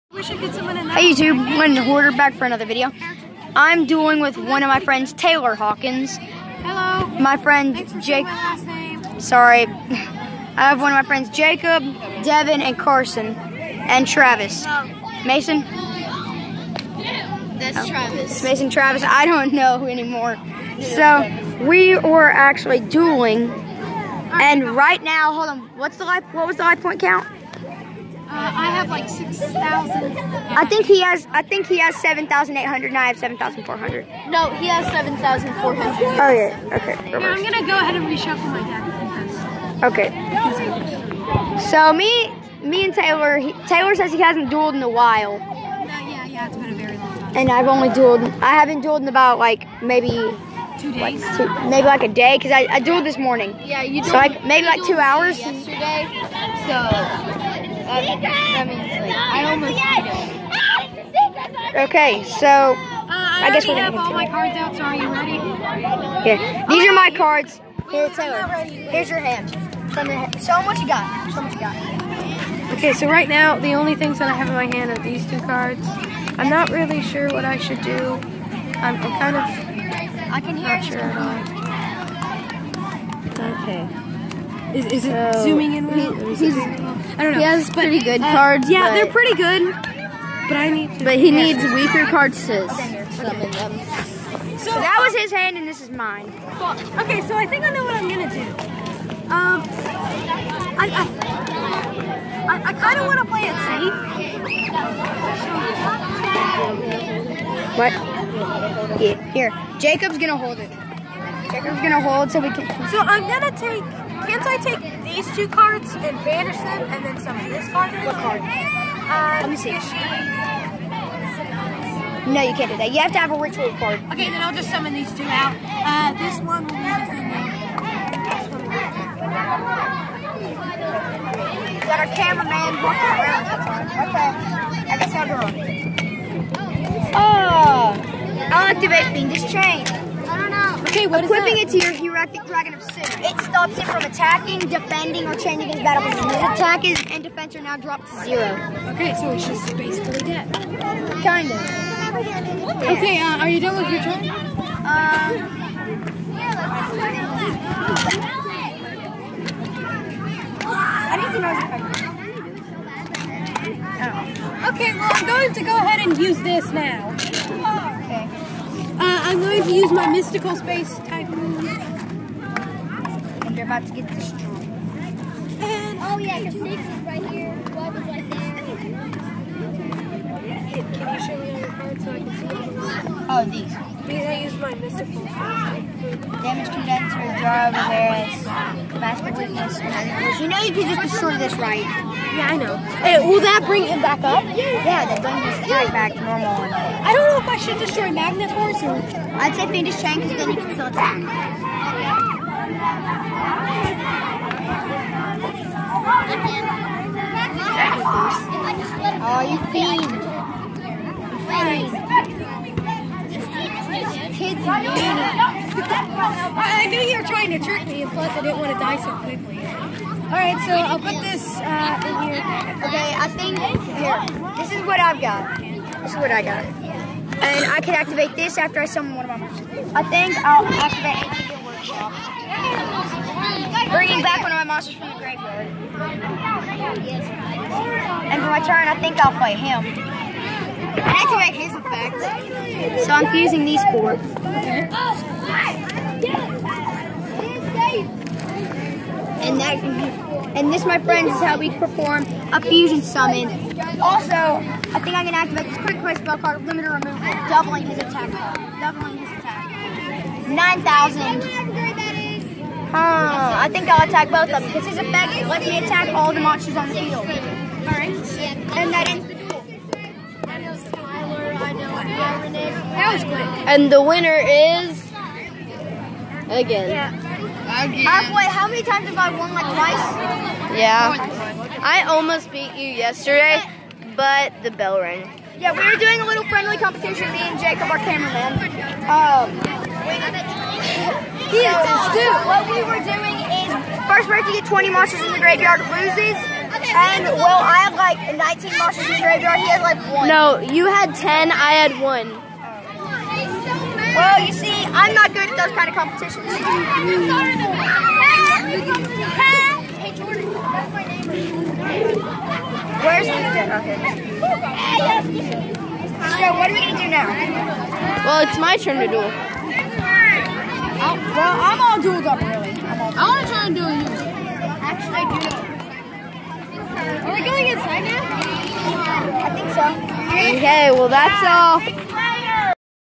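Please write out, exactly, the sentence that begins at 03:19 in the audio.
I'd say Fiendish Chain because then you can still attack.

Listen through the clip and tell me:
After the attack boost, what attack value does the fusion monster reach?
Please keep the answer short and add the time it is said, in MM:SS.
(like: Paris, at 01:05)
9000, at 04:20.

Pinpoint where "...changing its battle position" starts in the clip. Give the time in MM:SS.
02:25.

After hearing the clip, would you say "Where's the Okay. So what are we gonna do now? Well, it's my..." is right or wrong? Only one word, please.
right.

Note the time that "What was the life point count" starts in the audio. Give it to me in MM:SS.
00:26.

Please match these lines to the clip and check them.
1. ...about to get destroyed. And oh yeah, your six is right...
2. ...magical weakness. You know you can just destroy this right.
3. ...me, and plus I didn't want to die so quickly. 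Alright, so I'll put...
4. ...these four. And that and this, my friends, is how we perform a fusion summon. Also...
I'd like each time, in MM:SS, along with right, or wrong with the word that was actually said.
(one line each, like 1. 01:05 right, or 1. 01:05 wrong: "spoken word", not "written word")
1. 02:53 right
2. 03:08 right
3. 03:37 right
4. 04:03 right.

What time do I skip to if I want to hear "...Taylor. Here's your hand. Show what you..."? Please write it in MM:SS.
01:08.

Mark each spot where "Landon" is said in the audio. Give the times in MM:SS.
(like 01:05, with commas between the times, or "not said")
00:01.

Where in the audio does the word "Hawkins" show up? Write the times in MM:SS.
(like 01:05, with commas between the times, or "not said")
00:05.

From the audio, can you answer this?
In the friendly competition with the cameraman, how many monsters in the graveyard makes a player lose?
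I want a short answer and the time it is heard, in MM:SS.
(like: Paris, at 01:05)
20, at 04:54.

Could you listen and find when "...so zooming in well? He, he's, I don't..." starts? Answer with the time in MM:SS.
01:25.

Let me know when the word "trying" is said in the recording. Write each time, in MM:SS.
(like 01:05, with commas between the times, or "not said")
03:37.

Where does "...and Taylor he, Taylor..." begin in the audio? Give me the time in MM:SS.
00:42.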